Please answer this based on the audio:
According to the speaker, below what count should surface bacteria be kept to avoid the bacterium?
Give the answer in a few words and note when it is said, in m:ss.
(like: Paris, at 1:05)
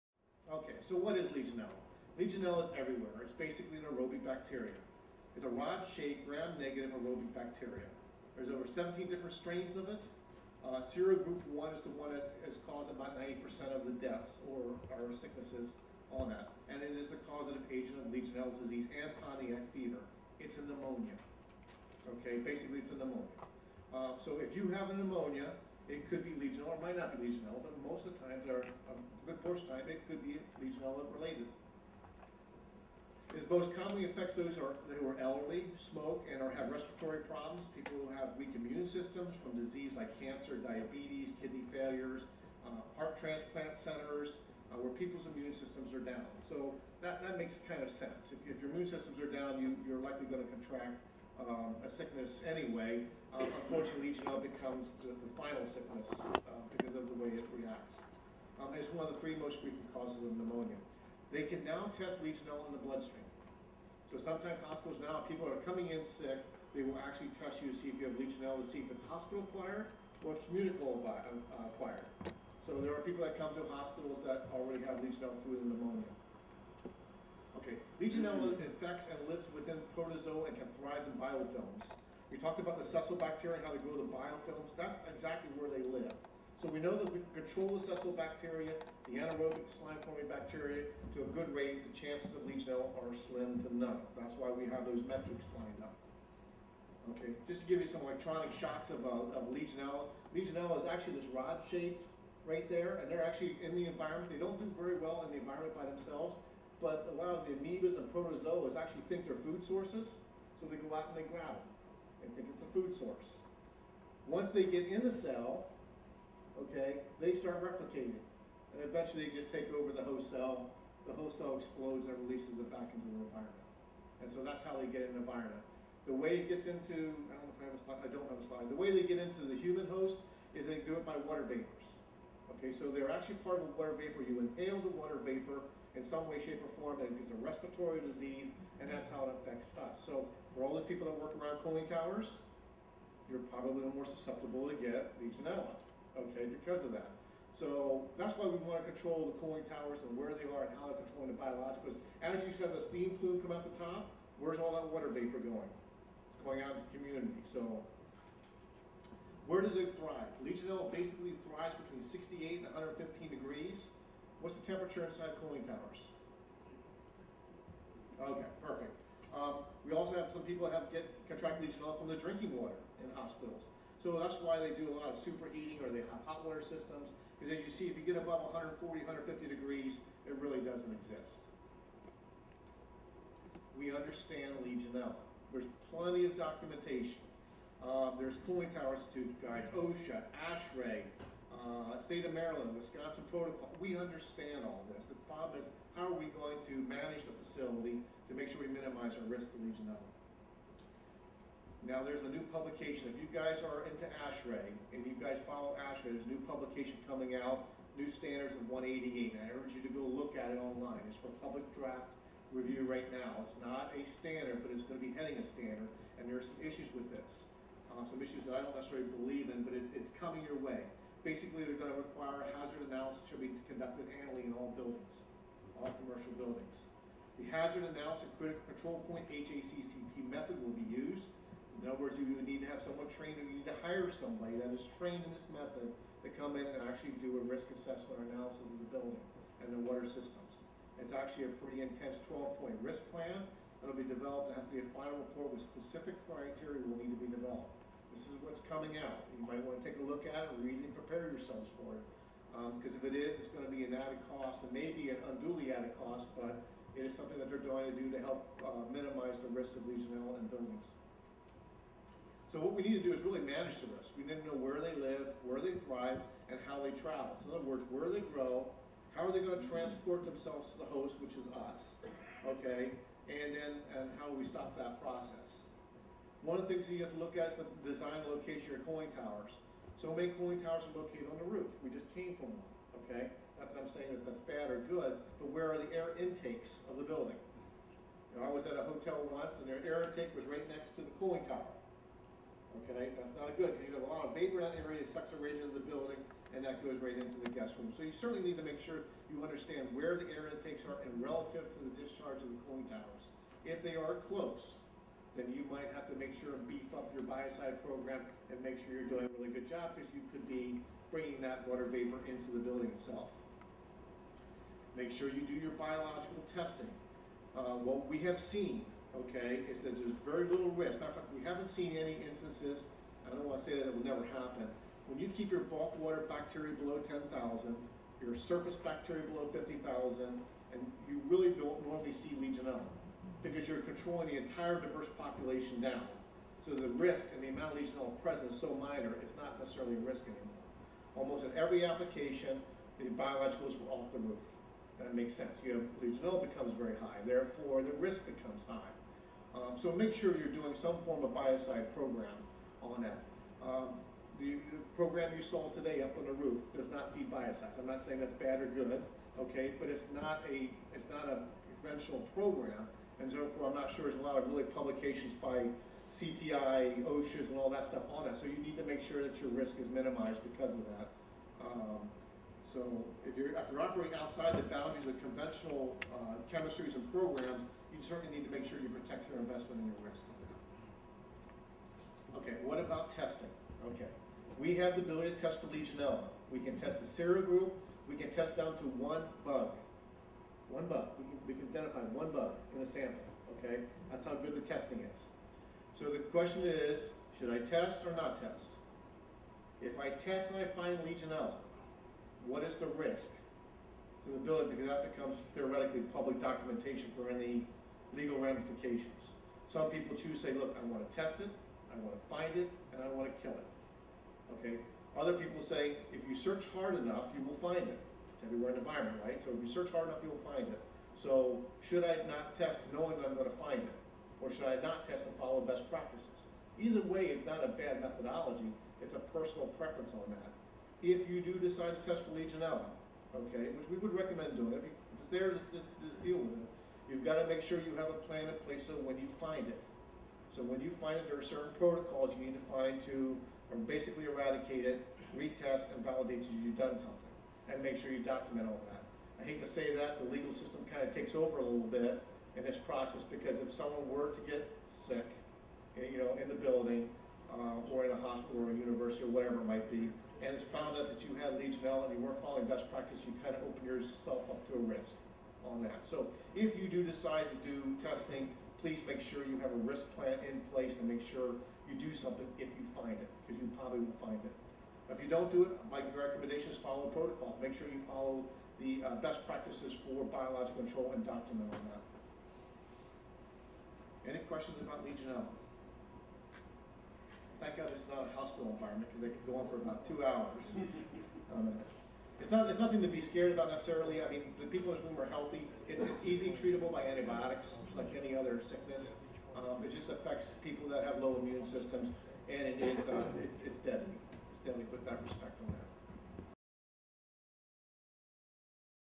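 50,000, at 5:29.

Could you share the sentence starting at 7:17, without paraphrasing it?
You've got to make sure you have a plan in place so when you find it.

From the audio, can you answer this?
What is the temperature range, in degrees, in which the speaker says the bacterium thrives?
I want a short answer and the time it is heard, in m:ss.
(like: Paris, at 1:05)
68 to 115 degrees, at 2:41.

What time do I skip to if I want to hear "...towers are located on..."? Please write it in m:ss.
4:40.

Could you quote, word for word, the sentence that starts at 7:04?
Or should I not test and follow best practices?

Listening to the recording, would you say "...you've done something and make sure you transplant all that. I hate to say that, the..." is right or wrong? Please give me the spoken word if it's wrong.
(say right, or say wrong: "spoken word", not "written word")
wrong: "document", not "transplant".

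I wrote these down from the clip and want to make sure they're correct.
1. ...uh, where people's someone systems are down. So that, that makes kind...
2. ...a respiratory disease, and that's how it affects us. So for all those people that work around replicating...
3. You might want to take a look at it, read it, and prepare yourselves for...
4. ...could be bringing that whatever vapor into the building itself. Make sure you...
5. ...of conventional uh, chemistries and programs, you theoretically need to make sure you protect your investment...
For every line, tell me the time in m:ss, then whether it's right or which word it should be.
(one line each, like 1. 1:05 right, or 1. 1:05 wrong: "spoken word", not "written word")
1. 0:44 wrong: "immune", not "someone"
2. 2:17 wrong: "cooling", not "replicating"
3. 4:09 right
4. 5:10 wrong: "water", not "whatever"
5. 6:15 wrong: "certainly", not "theoretically".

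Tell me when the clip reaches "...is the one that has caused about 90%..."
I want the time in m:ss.
0:11.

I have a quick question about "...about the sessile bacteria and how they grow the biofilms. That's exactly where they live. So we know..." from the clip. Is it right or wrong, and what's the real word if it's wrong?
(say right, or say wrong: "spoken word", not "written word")
right.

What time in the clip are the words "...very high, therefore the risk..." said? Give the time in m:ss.
5:46.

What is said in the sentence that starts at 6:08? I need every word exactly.
So you need to make sure that your risk is minimized because of that.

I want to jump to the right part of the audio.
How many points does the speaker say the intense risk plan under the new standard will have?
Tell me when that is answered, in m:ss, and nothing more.
4:02.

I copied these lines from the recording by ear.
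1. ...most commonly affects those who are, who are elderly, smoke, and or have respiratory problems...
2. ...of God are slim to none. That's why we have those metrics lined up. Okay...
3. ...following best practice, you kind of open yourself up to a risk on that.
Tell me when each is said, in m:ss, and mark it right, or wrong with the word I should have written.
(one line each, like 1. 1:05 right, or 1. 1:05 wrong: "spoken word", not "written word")
1. 0:33 right
2. 1:32 wrong: "Legionella", not "God"
3. 7:42 right.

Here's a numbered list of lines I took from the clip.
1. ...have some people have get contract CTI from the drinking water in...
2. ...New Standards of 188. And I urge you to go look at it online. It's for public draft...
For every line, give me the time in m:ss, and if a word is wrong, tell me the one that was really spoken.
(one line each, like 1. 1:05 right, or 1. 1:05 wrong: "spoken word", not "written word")
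1. 2:50 wrong: "Legionella", not "CTI"
2. 3:27 right.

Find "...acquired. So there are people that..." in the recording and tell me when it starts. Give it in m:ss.
1:11.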